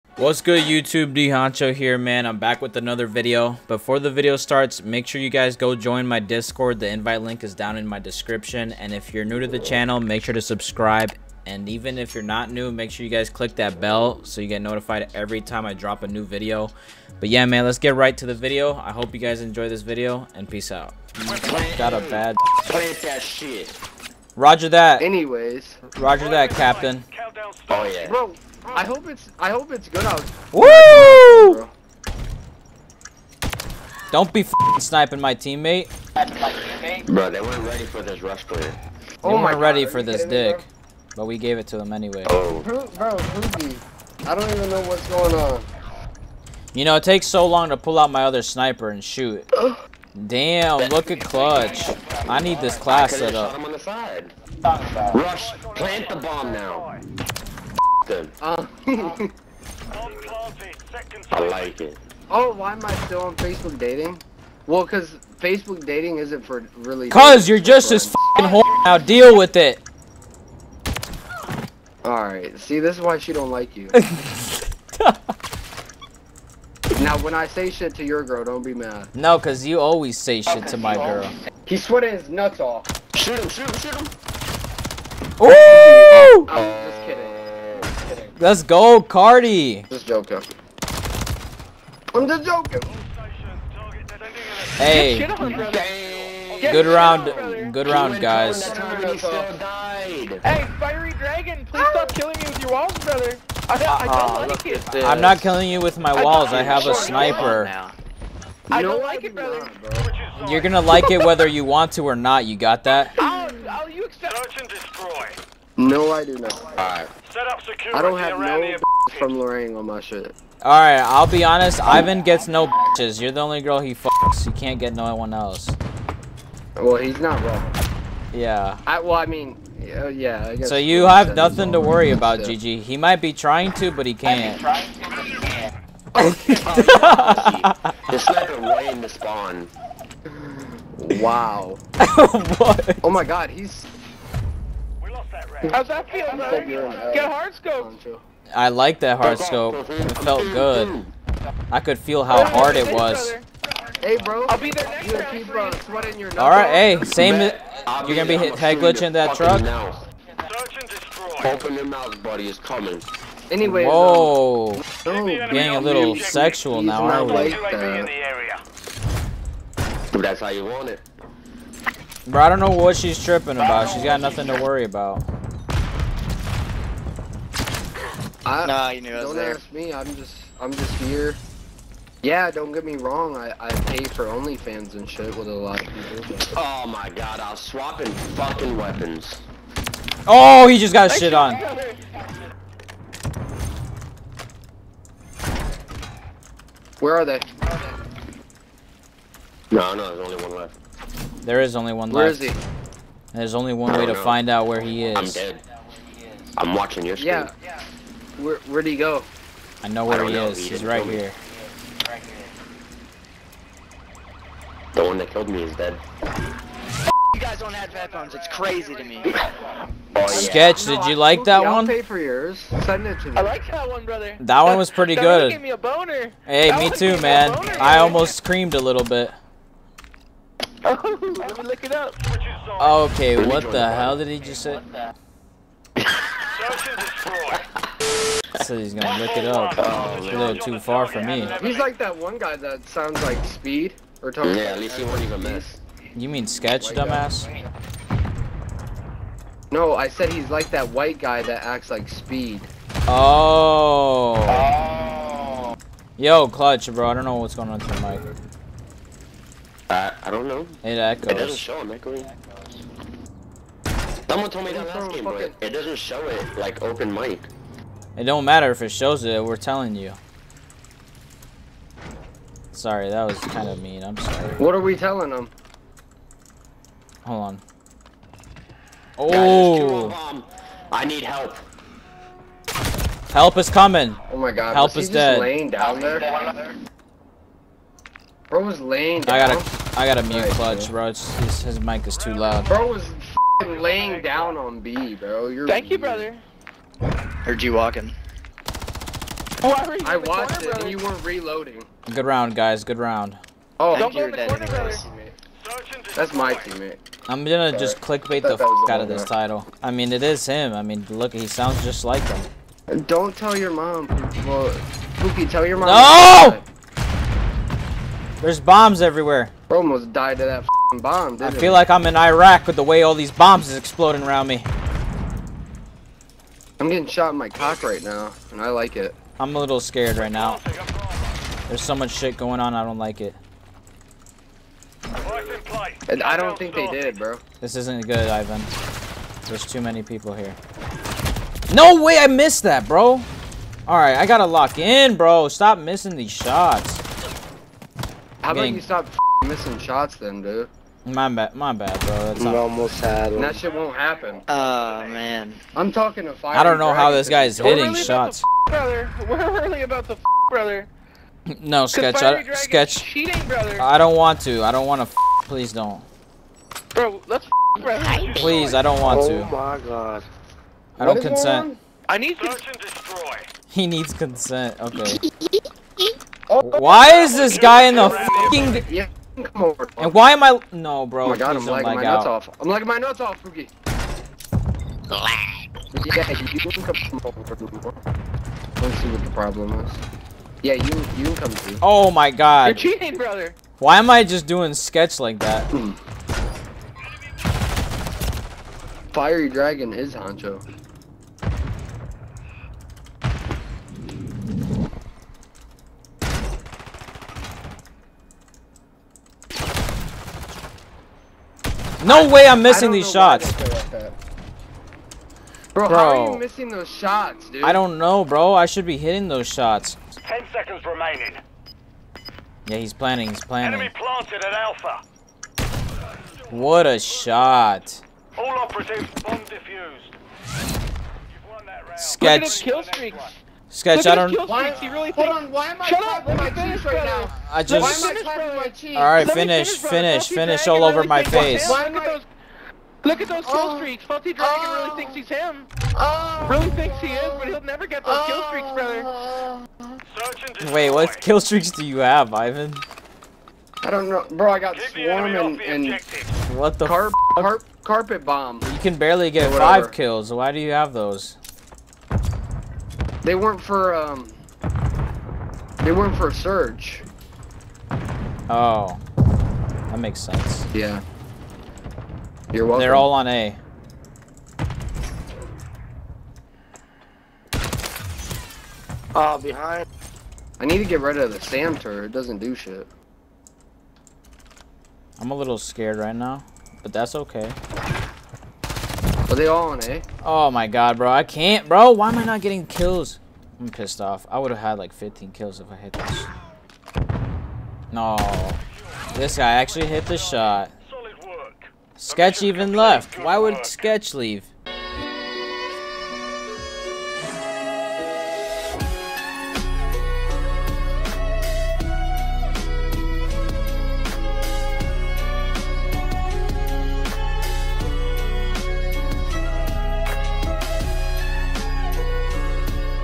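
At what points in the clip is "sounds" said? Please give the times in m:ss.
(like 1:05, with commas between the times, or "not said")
4:02, 5:11.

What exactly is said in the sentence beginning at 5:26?
I'm getting shot in my cock right now, and I like it.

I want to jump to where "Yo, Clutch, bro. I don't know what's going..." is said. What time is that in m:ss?
4:16.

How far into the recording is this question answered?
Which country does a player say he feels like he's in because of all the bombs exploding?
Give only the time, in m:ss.
5:22.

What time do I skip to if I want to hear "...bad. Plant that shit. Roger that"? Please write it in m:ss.
0:22.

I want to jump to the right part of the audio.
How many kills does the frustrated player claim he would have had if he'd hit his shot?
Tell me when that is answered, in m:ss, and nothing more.
8:14.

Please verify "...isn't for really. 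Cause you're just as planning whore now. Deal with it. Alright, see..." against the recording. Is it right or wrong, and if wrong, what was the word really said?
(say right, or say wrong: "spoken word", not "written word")
wrong: "fucking", not "planning".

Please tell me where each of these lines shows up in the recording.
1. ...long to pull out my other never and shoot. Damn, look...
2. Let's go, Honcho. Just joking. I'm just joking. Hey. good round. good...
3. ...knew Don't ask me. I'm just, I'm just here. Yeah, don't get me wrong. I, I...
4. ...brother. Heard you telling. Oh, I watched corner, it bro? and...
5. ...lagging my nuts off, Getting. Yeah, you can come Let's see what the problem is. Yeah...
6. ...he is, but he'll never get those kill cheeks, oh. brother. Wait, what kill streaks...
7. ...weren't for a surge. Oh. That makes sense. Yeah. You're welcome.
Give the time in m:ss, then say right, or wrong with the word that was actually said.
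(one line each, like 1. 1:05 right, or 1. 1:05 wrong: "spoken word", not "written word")
1. 0:47 wrong: "sniper", not "never"
2. 1:28 wrong: "Cardi", not "Honcho"
3. 2:58 right
4. 4:55 wrong: "walking", not "telling"
5. 6:22 wrong: "Fugi", not "Getting"
6. 7:26 wrong: "streaks", not "cheeks"
7. 7:45 right.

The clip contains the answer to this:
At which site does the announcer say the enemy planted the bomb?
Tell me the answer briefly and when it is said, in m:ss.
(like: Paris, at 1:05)
Alpha, at 7:04.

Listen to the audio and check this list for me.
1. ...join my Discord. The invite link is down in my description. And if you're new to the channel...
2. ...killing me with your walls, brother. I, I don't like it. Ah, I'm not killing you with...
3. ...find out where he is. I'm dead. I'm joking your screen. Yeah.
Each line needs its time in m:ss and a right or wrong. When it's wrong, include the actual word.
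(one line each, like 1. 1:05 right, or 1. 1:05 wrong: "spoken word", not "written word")
1. 0:05 right
2. 1:42 right
3. 3:24 wrong: "watching", not "joking".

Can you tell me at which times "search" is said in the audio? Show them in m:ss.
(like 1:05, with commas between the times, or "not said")
1:54, 6:12.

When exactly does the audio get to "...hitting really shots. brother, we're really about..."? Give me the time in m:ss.
5:57.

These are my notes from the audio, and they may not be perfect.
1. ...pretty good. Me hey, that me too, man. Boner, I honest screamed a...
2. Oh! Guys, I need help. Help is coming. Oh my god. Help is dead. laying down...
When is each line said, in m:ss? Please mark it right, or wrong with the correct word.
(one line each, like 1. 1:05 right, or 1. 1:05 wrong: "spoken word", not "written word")
1. 3:44 wrong: "almost", not "honest"
2. 4:39 right.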